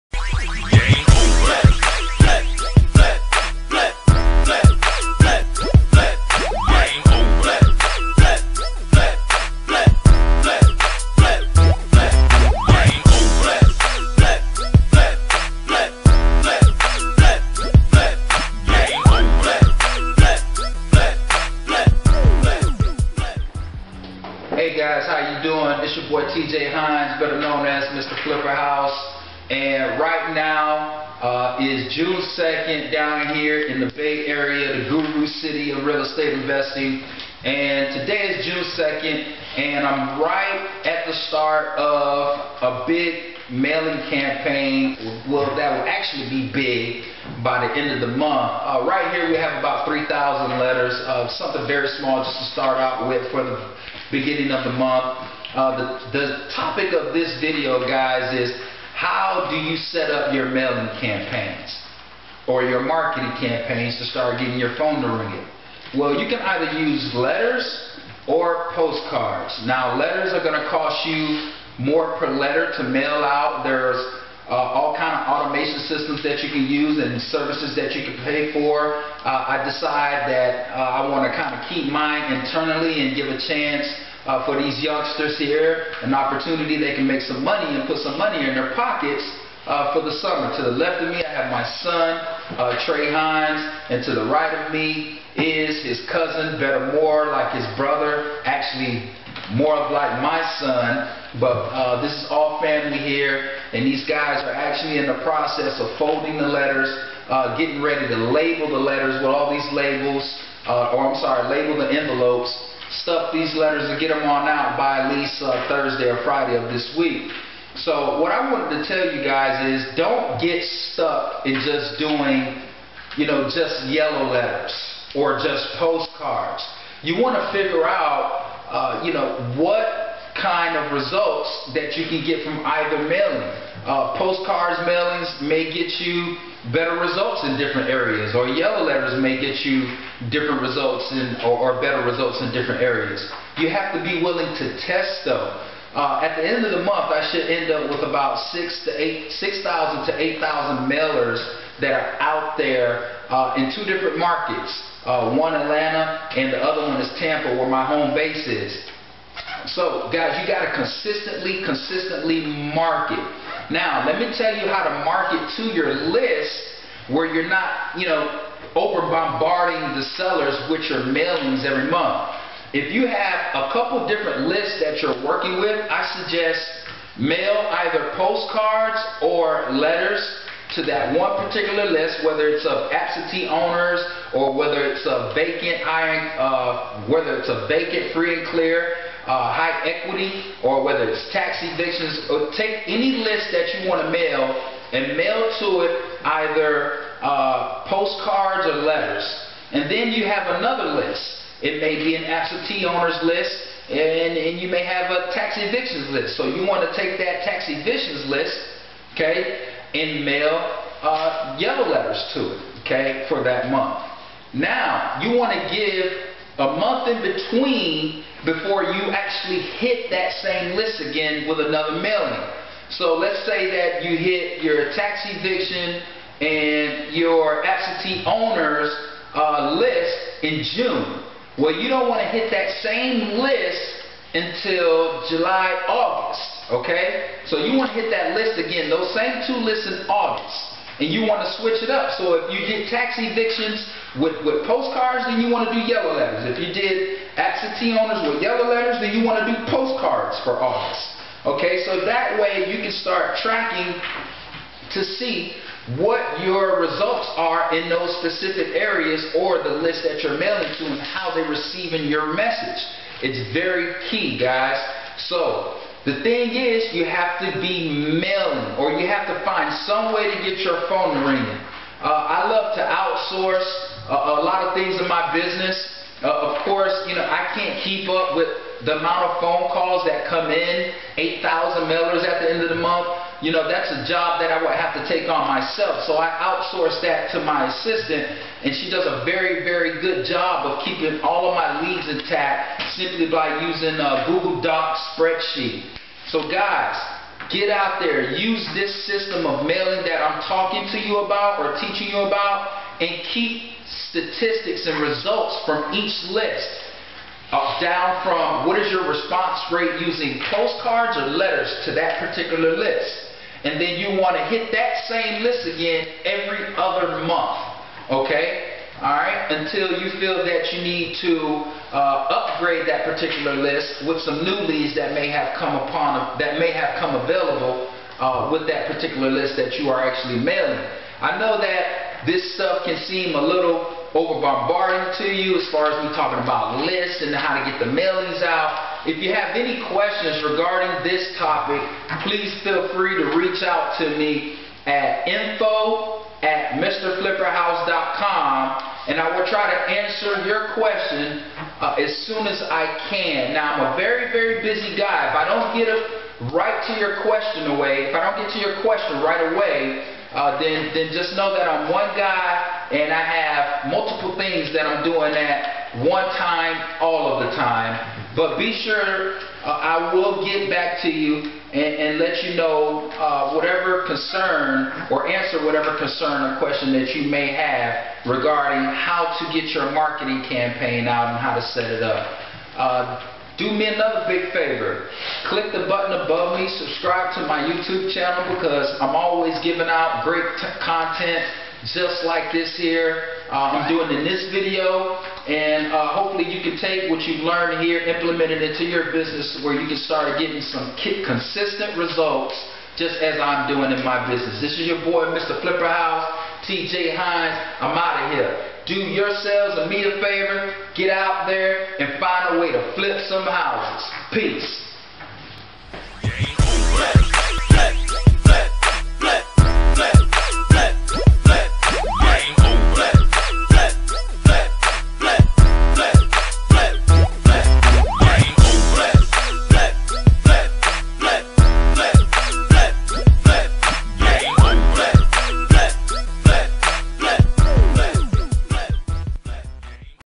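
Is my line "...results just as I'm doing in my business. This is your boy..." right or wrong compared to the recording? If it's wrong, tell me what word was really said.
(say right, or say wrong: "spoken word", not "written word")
right.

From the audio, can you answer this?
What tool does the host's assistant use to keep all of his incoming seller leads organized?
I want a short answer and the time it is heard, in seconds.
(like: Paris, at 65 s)
Google Docs spreadsheet, at 294 s.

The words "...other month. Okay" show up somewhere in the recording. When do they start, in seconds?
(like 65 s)
316 s.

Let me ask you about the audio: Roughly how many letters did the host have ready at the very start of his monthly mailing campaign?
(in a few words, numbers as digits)
3,000.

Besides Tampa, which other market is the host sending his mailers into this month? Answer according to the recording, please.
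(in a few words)
Atlanta.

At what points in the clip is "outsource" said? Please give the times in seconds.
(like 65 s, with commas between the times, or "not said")
272 s, 286 s.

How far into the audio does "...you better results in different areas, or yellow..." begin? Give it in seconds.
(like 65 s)
136 s.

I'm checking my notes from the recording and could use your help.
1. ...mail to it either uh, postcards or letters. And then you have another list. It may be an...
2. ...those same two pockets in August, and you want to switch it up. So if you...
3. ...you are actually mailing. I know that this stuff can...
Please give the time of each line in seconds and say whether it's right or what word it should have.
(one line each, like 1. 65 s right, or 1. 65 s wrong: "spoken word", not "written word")
1. 195 s right
2. 238 s wrong: "lists", not "pockets"
3. 329 s right.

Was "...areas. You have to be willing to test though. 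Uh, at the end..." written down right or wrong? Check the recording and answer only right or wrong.
right.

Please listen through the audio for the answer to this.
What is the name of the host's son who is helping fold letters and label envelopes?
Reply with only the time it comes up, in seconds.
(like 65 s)
92 s.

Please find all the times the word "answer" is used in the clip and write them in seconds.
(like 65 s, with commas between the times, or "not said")
349 s, 375 s.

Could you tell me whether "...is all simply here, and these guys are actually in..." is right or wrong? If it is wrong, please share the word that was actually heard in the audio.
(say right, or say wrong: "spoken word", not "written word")
wrong: "family", not "simply".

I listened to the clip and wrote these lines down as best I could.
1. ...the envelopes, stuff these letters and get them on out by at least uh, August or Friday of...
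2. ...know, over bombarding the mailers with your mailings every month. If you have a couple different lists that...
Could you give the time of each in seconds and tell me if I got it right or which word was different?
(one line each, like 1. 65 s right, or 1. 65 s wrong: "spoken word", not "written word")
1. 111 s wrong: "Thursday", not "August"
2. 168 s wrong: "sellers", not "mailers".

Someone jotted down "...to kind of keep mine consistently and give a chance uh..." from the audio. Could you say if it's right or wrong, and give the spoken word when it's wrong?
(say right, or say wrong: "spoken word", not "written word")
wrong: "internally", not "consistently".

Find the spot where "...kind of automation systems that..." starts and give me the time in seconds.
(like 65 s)
74 s.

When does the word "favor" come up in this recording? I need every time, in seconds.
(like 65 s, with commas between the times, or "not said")
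384 s, 410 s.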